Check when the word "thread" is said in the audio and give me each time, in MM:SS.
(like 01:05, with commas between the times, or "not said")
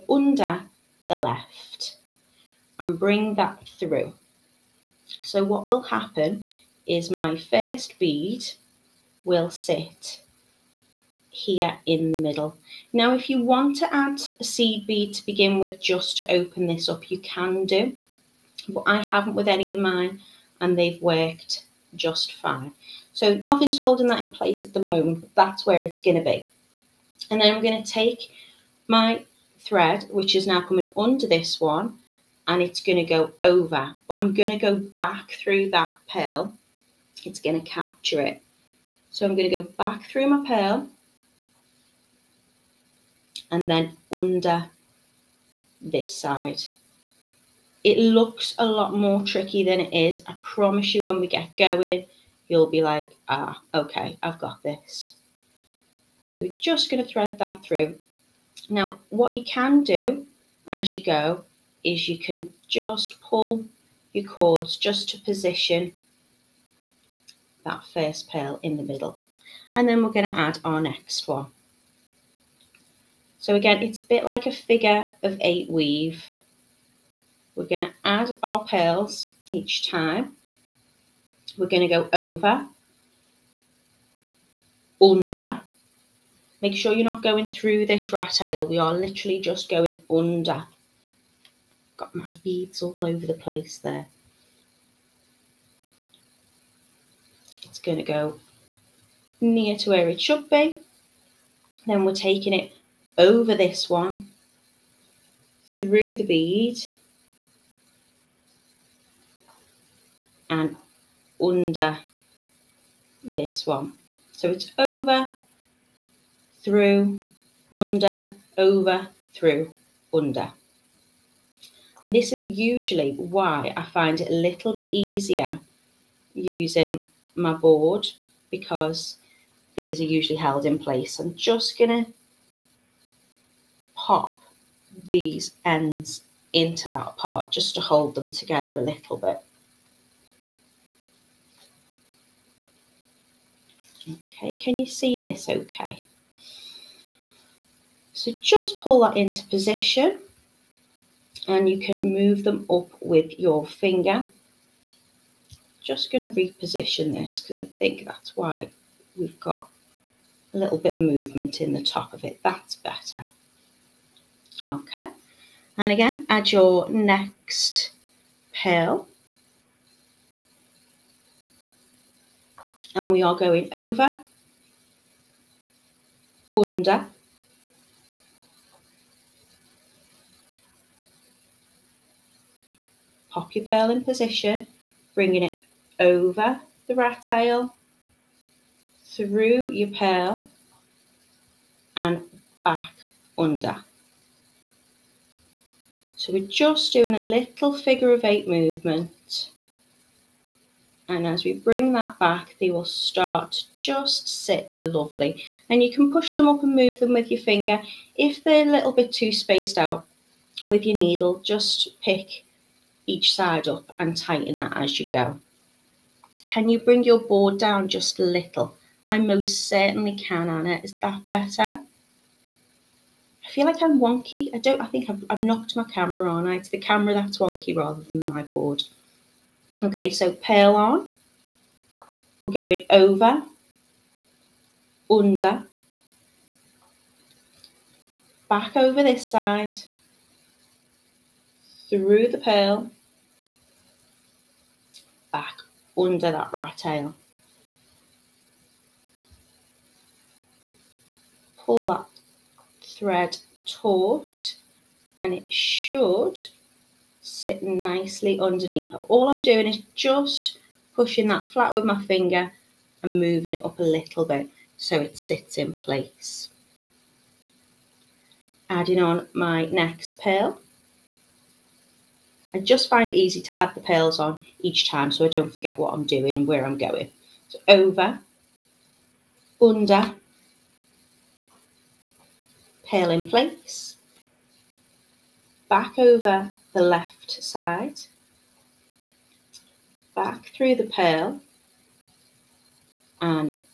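00:29, 00:57, 04:12.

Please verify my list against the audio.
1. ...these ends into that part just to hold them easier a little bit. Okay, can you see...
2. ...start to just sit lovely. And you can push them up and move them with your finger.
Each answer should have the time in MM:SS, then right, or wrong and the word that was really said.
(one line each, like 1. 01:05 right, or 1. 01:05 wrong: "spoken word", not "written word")
1. 02:15 wrong: "together", not "easier"
2. 03:22 right.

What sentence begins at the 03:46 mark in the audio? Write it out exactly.
It's the camera that's wonky rather than my board.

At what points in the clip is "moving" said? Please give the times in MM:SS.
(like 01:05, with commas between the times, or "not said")
04:23.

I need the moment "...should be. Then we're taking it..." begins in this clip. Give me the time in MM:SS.
01:40.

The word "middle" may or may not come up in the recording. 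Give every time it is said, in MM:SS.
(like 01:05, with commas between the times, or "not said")
00:12, 01:08.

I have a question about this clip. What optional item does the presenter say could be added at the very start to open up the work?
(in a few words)
A seed bead.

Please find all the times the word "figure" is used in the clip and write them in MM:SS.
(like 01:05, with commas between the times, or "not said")
01:14, 03:17.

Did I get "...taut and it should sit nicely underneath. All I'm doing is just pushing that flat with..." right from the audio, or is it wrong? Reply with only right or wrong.
right.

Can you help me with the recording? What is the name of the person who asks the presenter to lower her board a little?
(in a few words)
Anna.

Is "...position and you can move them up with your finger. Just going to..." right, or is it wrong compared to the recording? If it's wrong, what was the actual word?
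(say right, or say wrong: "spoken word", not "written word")
right.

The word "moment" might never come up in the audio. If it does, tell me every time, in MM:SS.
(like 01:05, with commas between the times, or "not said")
00:24.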